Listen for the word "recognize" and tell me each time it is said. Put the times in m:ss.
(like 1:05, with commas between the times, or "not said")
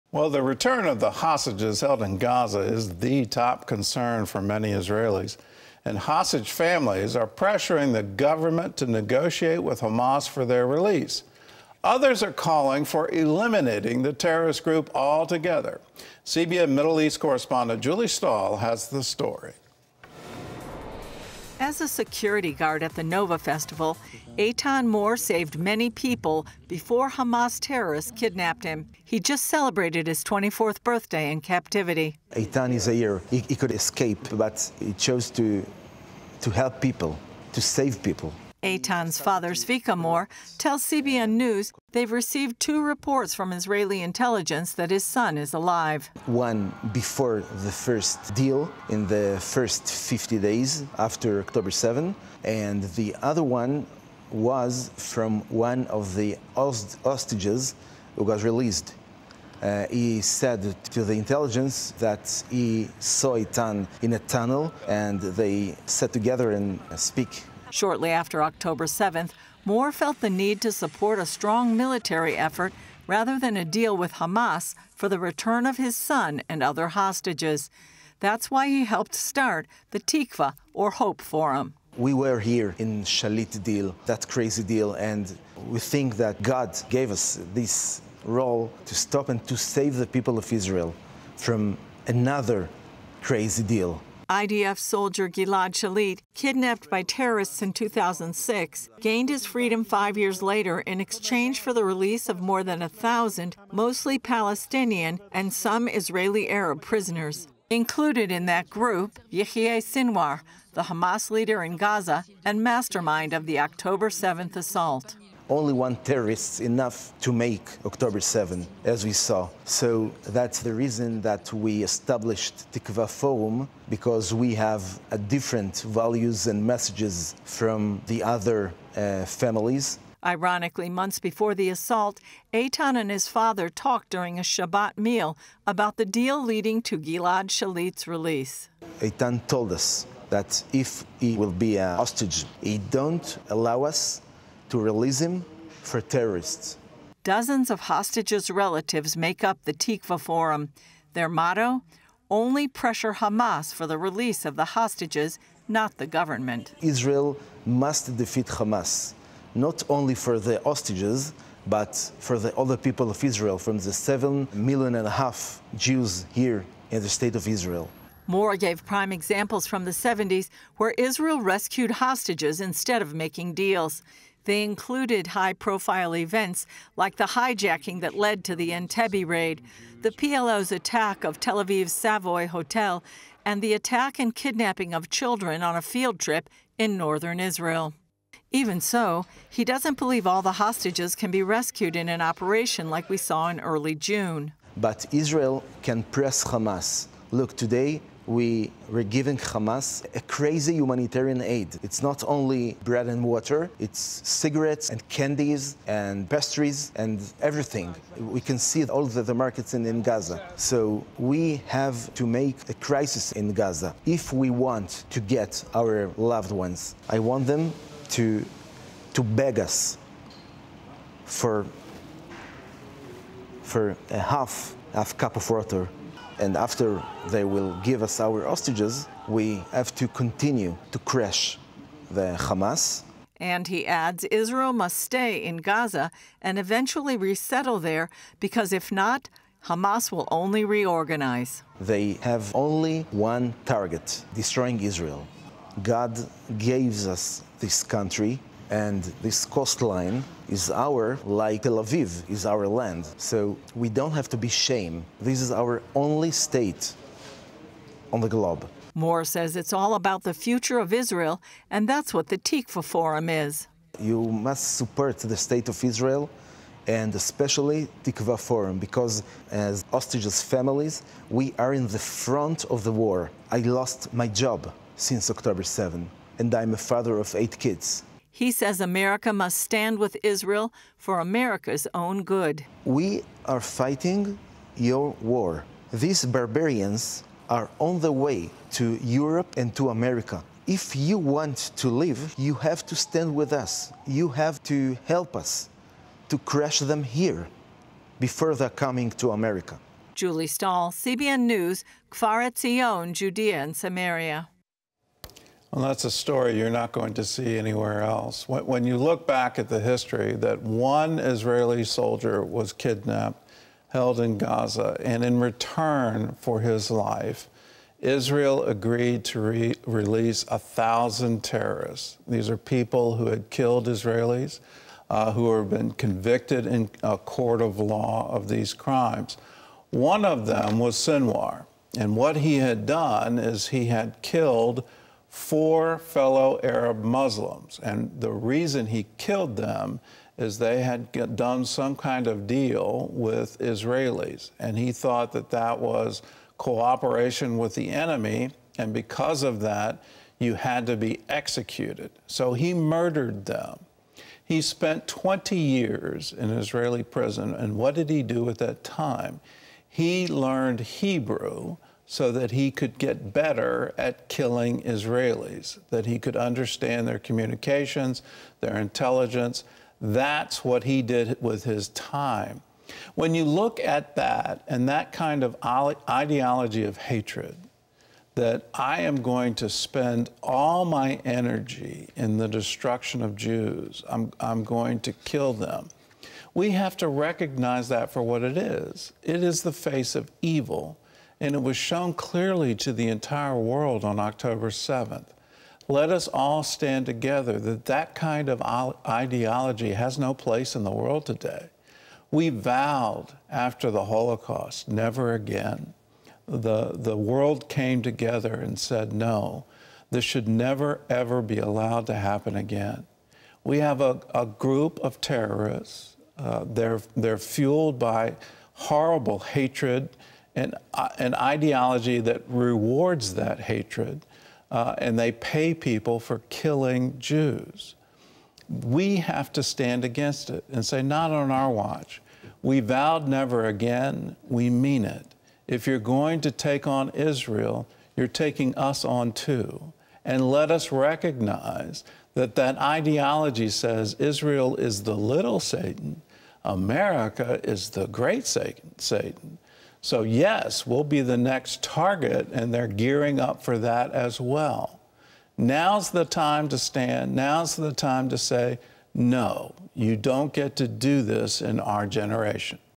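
6:27, 7:20.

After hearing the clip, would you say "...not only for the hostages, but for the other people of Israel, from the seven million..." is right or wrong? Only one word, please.
right.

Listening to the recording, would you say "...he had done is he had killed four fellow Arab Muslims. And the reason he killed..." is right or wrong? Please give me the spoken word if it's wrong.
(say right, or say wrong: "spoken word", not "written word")
right.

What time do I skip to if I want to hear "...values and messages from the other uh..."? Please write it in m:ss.
2:05.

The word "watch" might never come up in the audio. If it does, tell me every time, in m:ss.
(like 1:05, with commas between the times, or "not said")
7:11.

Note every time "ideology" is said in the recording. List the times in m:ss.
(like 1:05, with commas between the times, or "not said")
6:15, 6:39, 7:01, 7:22.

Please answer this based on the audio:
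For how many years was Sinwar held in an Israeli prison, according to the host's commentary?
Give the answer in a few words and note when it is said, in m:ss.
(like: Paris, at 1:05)
20, at 5:55.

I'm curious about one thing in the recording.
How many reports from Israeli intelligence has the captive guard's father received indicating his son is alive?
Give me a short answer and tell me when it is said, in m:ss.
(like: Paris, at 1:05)
2, at 0:42.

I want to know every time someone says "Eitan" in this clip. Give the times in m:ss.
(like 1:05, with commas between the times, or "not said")
0:24, 0:32, 0:38, 1:03, 2:12, 2:19.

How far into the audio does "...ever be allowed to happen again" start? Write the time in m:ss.
6:51.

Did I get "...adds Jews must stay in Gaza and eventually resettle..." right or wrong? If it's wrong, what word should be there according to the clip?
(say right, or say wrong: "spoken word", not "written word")
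wrong: "Israel", not "Jews".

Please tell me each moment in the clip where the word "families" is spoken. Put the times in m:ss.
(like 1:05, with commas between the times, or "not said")
0:06, 2:09, 4:30.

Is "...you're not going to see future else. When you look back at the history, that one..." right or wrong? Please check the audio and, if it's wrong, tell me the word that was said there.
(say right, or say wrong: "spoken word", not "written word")
wrong: "anywhere", not "future".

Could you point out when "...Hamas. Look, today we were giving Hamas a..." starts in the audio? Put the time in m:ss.
3:16.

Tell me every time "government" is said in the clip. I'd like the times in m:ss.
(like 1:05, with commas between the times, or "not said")
0:08, 2:36.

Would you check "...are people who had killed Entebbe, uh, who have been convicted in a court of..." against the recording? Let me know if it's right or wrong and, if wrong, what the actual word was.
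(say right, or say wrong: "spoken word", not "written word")
wrong: "Israelis", not "Entebbe".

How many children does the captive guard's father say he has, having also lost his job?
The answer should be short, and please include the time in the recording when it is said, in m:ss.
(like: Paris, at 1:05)
8, at 4:37.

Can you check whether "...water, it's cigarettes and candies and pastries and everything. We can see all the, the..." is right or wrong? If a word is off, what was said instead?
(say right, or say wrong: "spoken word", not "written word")
right.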